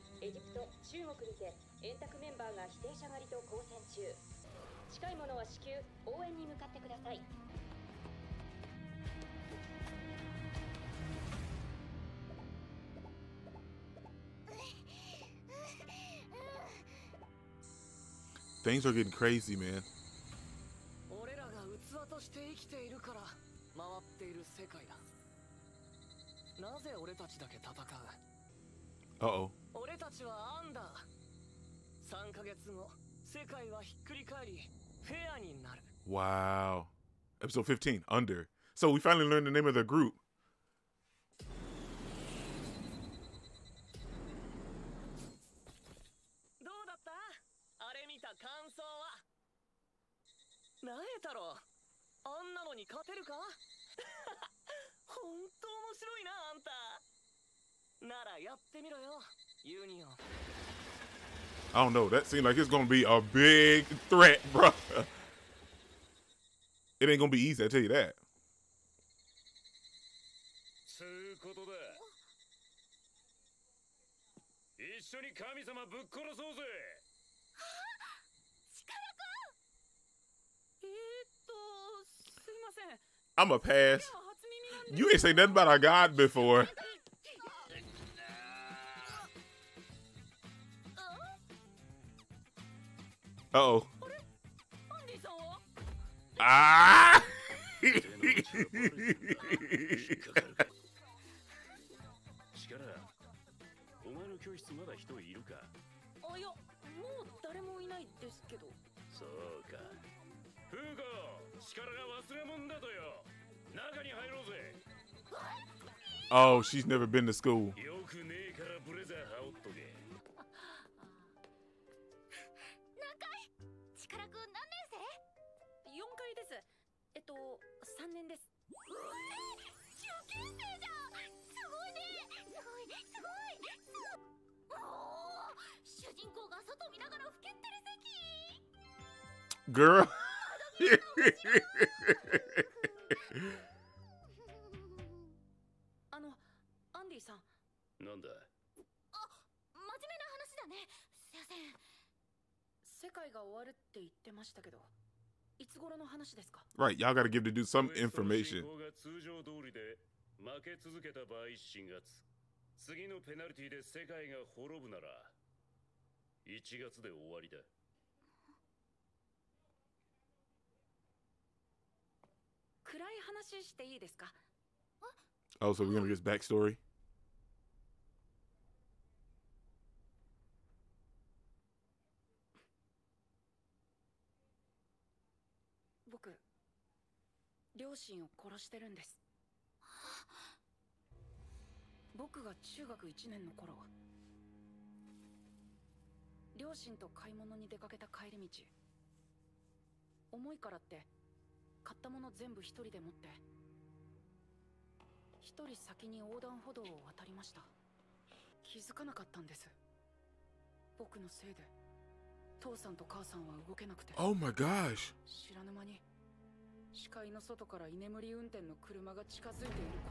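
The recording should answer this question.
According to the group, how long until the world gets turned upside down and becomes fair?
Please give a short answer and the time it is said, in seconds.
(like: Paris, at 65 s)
3 months, at 32 s.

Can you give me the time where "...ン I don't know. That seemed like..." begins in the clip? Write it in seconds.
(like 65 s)
60 s.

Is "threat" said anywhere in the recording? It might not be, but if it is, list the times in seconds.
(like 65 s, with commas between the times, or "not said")
64 s.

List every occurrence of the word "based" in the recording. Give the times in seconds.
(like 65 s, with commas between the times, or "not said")
not said.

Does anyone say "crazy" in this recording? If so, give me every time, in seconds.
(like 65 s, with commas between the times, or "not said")
19 s.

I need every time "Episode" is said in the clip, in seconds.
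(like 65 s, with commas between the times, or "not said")
37 s.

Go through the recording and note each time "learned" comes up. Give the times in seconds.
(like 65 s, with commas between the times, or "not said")
39 s.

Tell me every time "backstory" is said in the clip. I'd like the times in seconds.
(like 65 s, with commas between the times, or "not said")
176 s.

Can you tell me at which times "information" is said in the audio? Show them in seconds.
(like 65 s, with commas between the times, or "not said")
157 s.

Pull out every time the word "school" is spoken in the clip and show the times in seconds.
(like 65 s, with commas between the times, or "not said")
117 s.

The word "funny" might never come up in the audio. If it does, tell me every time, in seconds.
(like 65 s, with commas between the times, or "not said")
not said.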